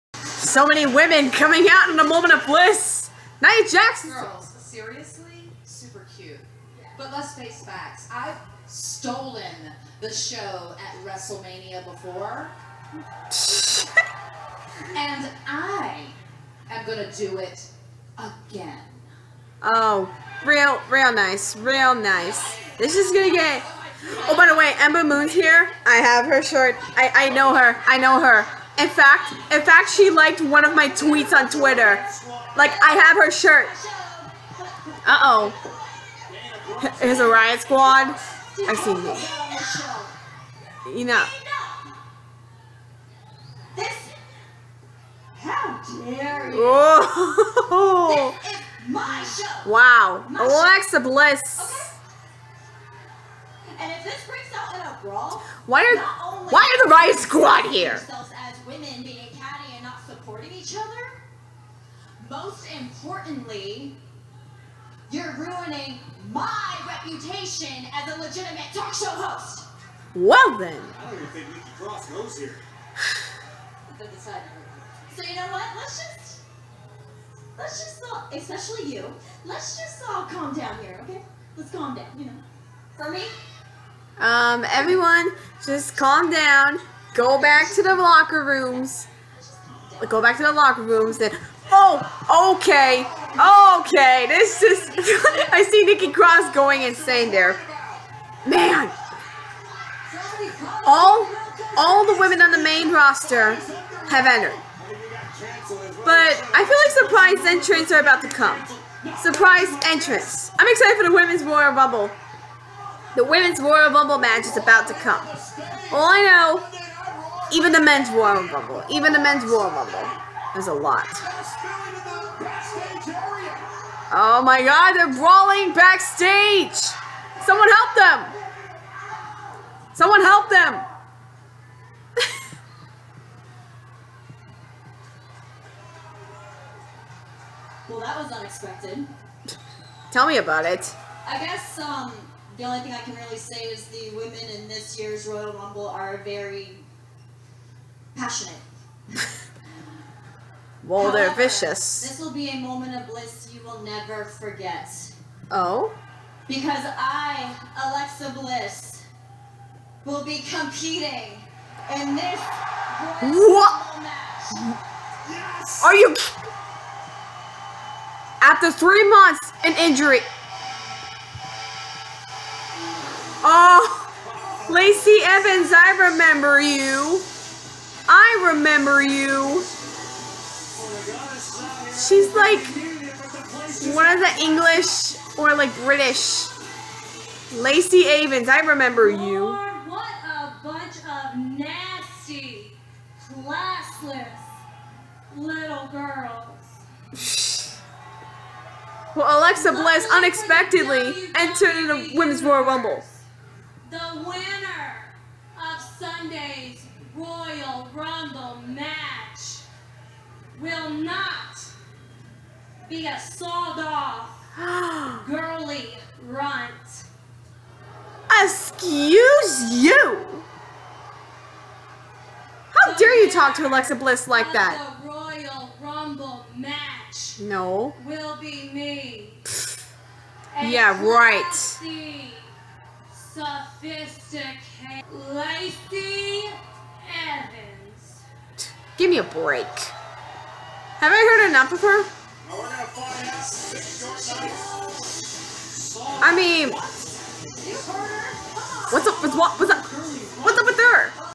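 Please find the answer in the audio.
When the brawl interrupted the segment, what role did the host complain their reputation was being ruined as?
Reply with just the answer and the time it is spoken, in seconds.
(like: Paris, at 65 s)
talk show host, at 68 s.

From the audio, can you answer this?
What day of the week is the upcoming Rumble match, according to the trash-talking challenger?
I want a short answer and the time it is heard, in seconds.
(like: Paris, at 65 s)
Sunday, at 205 s.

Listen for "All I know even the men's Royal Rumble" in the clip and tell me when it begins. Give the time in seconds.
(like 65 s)
115 s.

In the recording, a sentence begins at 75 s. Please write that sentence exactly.
Let's just let's just all, especially you.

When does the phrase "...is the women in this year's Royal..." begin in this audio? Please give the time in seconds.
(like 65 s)
143 s.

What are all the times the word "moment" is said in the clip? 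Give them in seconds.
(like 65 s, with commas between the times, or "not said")
2 s, 152 s.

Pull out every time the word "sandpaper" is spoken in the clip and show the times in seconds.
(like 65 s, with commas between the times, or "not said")
not said.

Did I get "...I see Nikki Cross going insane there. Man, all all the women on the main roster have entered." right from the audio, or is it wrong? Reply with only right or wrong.
right.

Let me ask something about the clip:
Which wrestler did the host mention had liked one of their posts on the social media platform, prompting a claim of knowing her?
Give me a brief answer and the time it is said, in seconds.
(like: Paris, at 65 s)
Ember Moon, at 24 s.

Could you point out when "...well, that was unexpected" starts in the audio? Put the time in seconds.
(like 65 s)
137 s.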